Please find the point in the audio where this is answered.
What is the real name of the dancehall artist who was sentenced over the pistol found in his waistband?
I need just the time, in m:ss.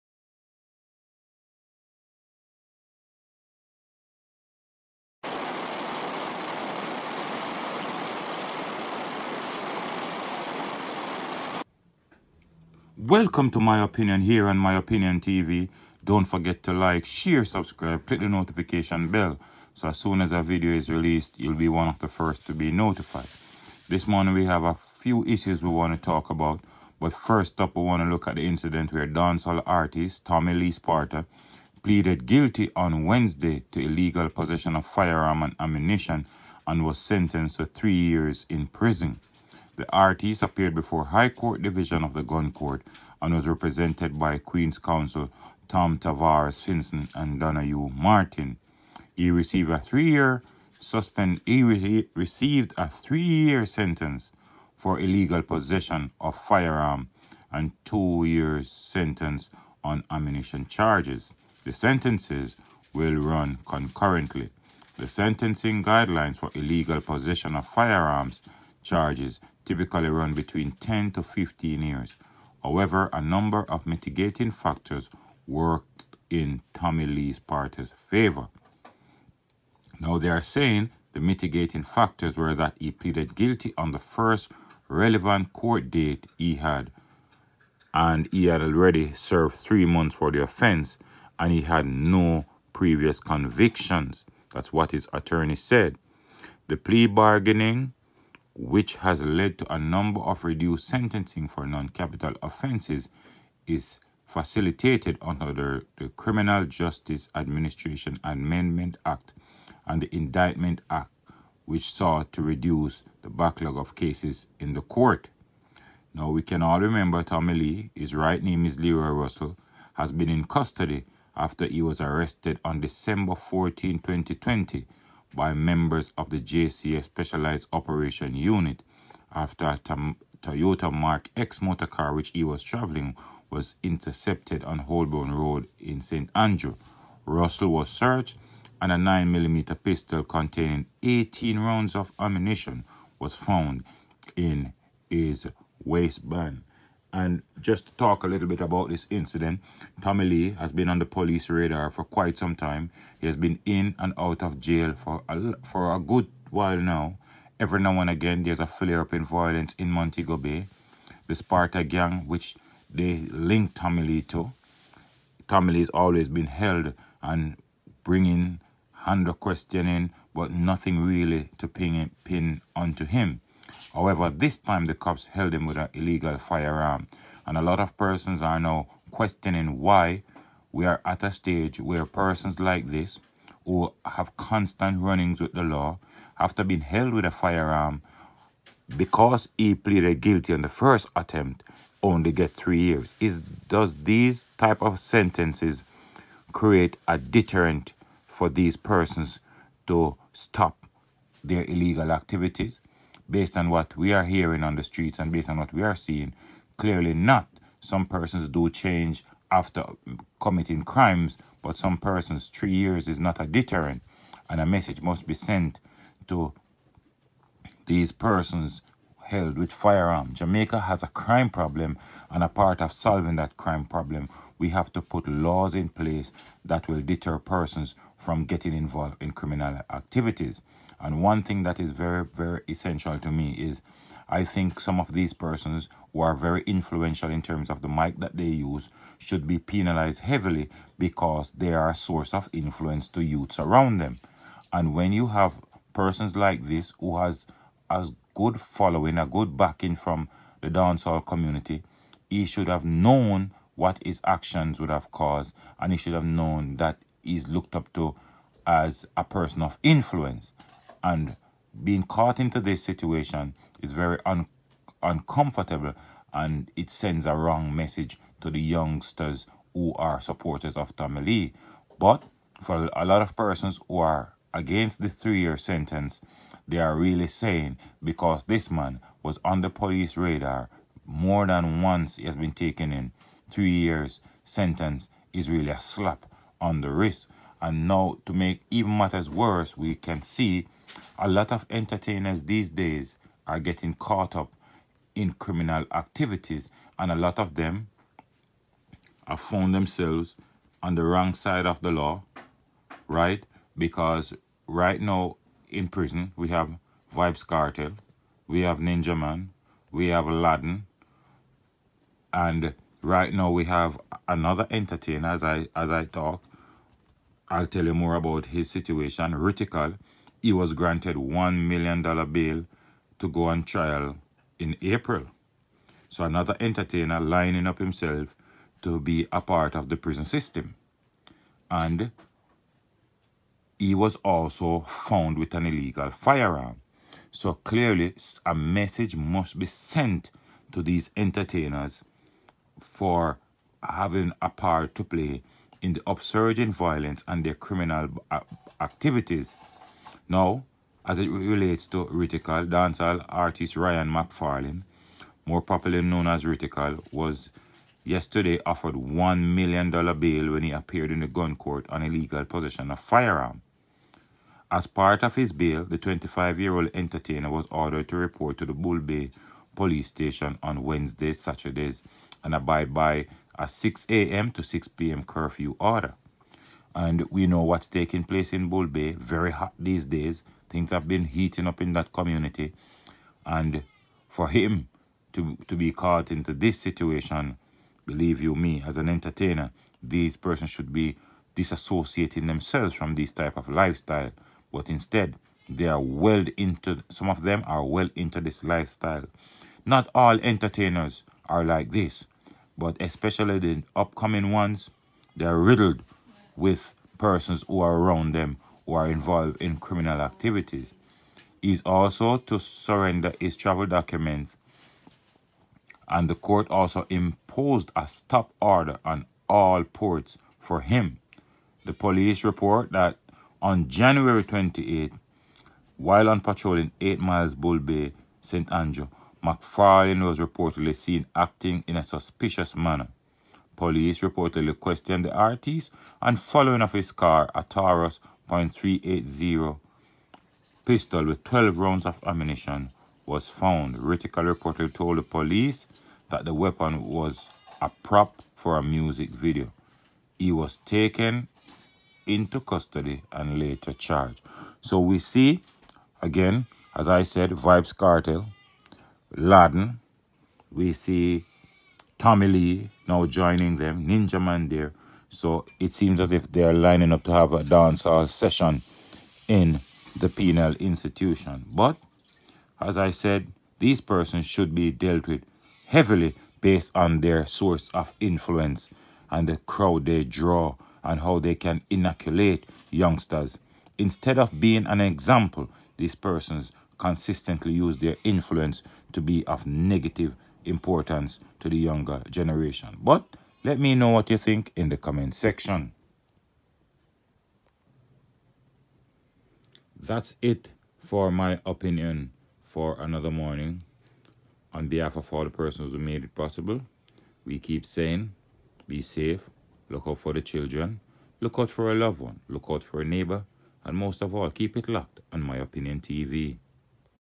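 1:58.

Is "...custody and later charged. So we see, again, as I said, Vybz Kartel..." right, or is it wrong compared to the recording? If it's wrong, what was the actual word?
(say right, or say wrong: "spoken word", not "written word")
right.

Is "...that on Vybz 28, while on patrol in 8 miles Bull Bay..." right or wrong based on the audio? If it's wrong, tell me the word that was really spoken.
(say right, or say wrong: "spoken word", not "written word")
wrong: "January", not "Vybz".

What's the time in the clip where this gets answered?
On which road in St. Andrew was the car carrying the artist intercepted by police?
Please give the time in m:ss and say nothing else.
2:14.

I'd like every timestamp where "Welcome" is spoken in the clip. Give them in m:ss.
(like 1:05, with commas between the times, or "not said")
0:13.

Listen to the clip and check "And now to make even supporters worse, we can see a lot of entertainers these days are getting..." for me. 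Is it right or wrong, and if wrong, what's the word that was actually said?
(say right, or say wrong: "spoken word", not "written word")
wrong: "matters", not "supporters".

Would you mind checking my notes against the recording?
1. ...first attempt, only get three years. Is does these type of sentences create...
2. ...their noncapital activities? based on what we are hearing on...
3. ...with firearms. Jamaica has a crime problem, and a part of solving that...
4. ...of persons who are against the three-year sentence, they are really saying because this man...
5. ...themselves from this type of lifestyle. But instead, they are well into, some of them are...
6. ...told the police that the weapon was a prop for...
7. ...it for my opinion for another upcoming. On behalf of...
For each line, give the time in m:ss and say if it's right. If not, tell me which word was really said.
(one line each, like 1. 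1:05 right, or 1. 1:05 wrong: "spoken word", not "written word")
1. 3:10 right
2. 3:21 wrong: "illegal", not "noncapital"
3. 3:39 right
4. 4:33 right
5. 6:32 right
6. 7:24 right
7. 8:20 wrong: "morning", not "upcoming".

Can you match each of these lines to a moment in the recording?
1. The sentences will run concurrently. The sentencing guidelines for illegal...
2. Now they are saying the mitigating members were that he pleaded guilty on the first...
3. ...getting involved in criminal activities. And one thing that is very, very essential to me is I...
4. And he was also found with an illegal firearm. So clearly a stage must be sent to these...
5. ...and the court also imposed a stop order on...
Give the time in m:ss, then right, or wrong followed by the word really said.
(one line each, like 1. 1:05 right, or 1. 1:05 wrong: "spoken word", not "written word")
1. 1:01 right
2. 1:19 wrong: "factors", not "members"
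3. 3:48 right
4. 5:31 wrong: "message", not "stage"
5. 6:56 right.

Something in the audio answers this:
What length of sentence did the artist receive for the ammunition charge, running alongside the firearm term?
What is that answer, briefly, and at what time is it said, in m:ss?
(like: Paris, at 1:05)
2 years, at 0:57.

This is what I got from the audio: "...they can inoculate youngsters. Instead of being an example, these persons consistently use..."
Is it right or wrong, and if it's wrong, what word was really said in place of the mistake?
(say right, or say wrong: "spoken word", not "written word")
right.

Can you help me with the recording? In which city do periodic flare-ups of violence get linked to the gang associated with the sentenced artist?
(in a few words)
Montego Bay.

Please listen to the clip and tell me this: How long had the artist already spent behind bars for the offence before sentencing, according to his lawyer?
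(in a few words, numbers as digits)
3 months.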